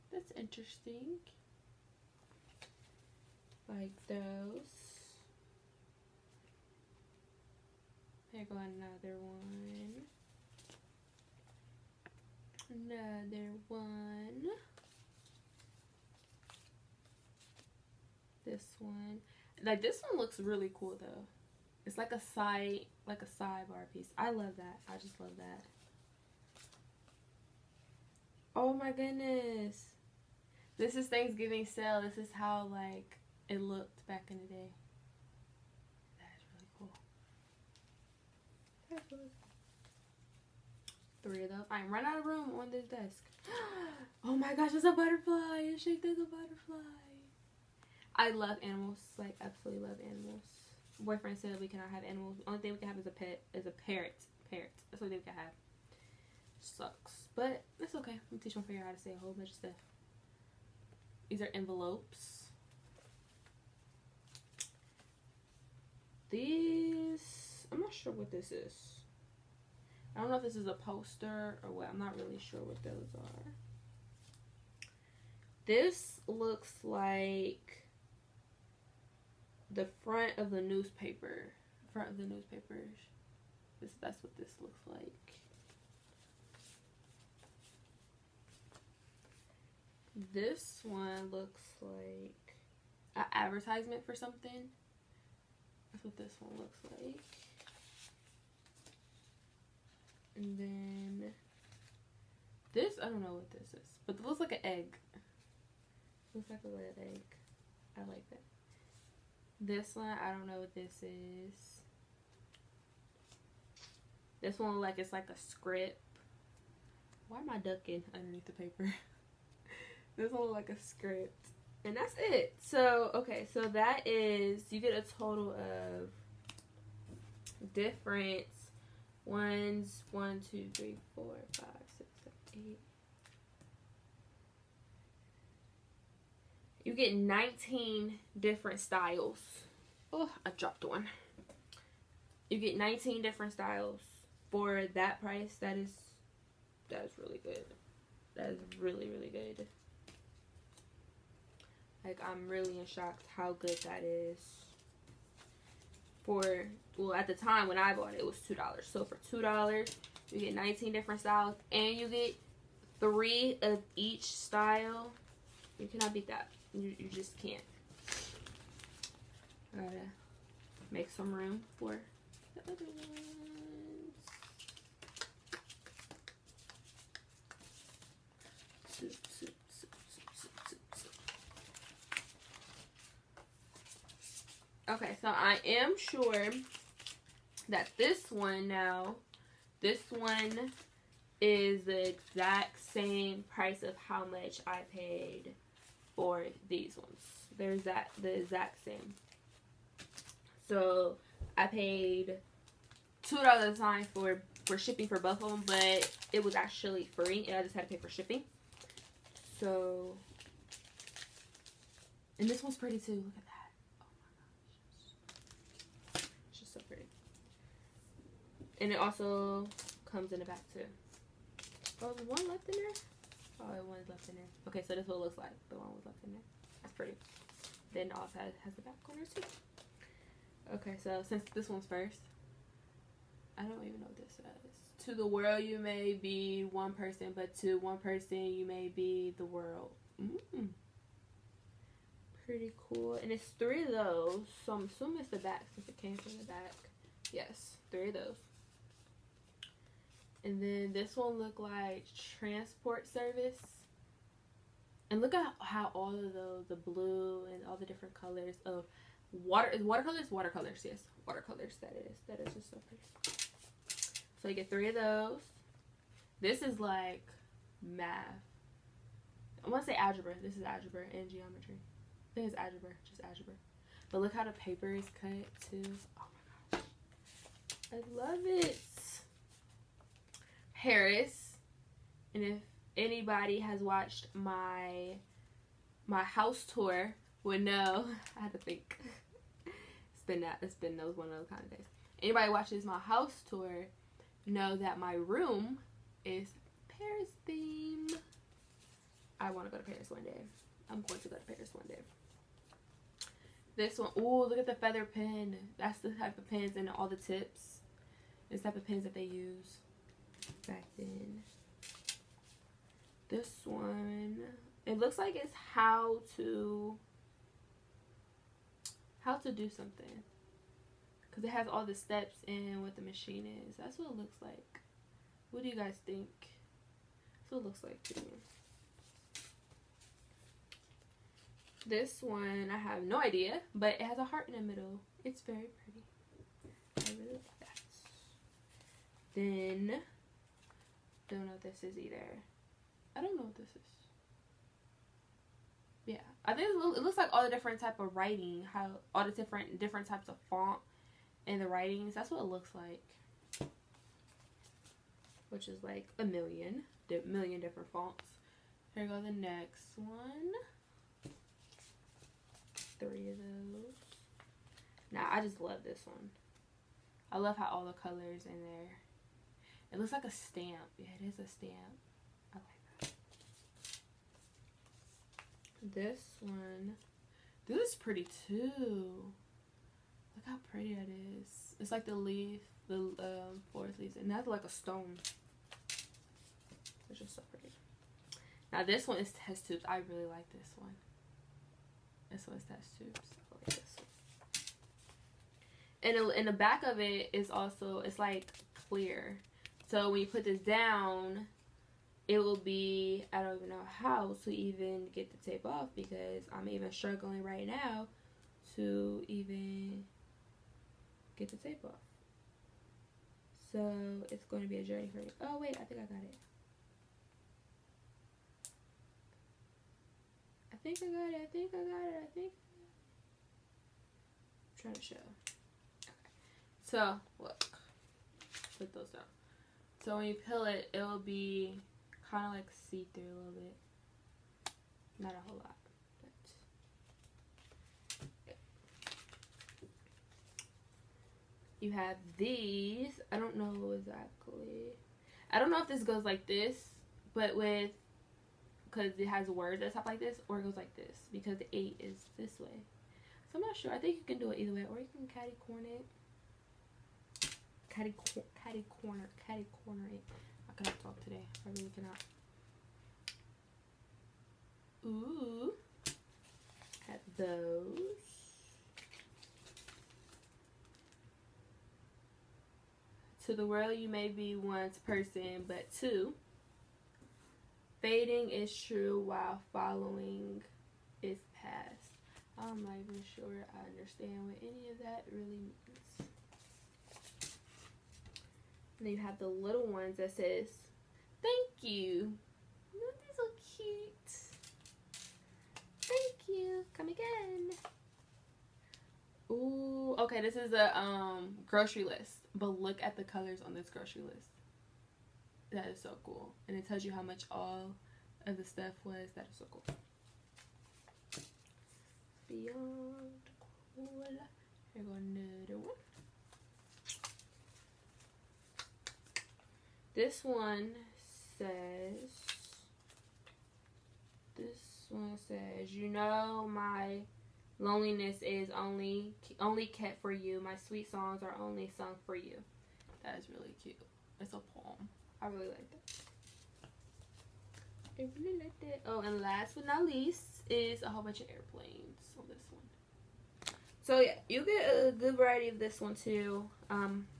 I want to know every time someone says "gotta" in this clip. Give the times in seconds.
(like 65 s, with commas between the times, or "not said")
169 s.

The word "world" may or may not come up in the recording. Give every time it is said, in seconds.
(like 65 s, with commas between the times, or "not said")
235 s, 239 s, 473 s.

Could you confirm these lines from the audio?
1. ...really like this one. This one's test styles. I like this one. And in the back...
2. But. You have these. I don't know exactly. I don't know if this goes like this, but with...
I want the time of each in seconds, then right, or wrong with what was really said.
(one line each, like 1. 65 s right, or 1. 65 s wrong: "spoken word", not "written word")
1. 390 s wrong: "tubes", not "styles"
2. 438 s right.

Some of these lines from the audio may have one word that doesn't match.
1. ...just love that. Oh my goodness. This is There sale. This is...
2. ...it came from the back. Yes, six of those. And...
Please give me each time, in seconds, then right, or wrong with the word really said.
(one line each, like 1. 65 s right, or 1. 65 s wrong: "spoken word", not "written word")
1. 24 s wrong: "Thanksgiving", not "There"
2. 245 s wrong: "three", not "six".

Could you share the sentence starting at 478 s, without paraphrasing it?
Fading is true while following is past.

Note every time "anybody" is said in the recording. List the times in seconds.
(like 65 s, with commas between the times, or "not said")
282 s, 292 s.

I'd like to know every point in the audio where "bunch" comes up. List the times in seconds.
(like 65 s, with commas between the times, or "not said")
59 s, 541 s.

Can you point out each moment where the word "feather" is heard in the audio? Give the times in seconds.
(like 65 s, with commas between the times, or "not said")
304 s.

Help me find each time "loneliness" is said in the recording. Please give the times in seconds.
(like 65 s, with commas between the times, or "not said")
527 s.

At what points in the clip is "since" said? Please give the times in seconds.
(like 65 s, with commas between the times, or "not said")
231 s, 245 s.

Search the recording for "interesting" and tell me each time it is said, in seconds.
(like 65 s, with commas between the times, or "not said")
0 s.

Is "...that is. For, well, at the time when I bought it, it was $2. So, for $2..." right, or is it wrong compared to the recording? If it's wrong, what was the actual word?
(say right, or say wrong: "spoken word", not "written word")
right.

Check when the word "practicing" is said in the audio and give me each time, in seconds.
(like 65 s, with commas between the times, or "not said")
not said.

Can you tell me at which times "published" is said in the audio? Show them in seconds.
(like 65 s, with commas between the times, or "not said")
not said.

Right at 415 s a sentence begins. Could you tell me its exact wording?
Oh, wait, I think I got it.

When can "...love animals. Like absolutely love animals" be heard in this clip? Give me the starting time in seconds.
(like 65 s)
48 s.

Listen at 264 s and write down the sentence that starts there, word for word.
So you get three of those.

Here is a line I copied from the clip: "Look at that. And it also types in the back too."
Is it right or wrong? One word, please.
wrong.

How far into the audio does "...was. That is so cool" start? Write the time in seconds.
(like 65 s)
509 s.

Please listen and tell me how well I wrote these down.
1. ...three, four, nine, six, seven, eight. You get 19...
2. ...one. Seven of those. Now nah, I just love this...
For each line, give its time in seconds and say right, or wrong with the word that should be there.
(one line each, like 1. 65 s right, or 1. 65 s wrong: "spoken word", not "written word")
1. 130 s wrong: "five", not "nine"
2. 359 s wrong: "Three", not "Seven".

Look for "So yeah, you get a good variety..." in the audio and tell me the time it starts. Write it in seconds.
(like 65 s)
544 s.